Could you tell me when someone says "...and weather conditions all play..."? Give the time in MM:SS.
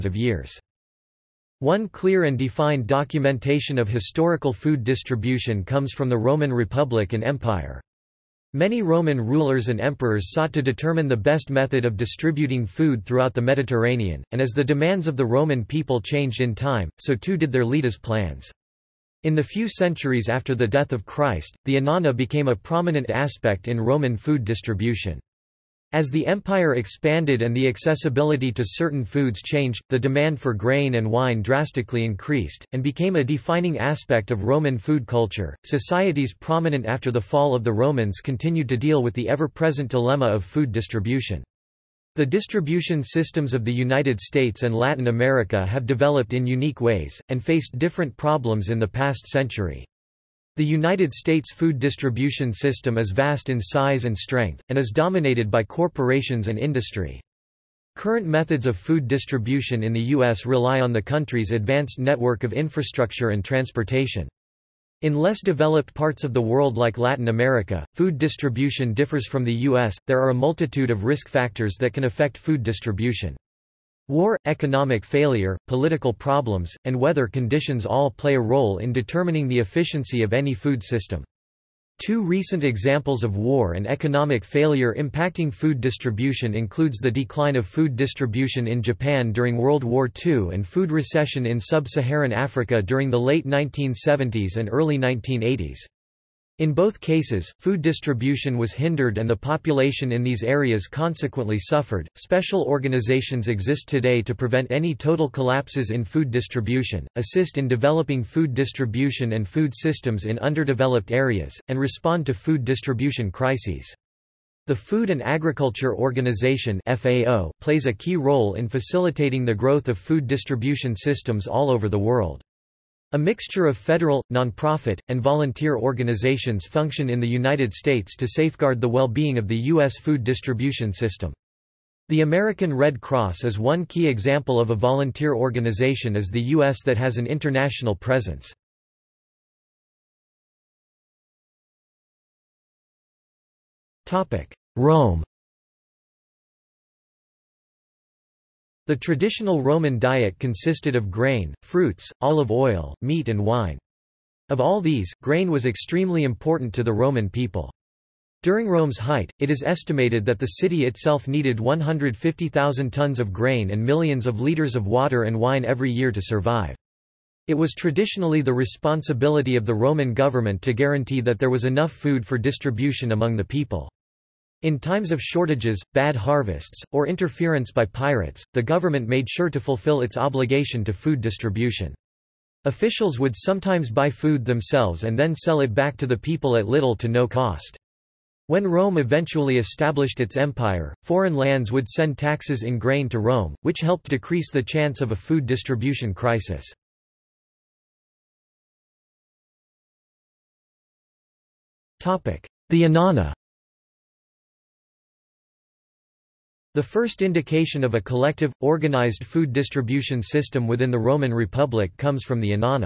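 01:16.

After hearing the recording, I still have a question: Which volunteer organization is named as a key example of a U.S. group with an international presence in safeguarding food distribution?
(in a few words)
American Red Cross.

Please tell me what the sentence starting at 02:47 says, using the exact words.
It was traditionally the responsibility of the Roman government to guarantee that there was enough food for distribution among the people.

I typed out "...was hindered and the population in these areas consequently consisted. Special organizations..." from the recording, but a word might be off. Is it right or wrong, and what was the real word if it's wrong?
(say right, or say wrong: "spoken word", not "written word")
wrong: "suffered", not "consisted".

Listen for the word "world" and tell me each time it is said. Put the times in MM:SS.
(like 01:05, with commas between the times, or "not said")
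01:06, 01:29, 02:01.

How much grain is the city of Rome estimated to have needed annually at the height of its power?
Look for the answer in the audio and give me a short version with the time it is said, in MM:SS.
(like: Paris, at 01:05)
150,000 tons, at 02:41.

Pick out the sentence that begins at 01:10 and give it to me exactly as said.
There are a multitude of risk factors that can affect food distribution.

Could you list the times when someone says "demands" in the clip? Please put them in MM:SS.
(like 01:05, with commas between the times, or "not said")
00:14, 00:29.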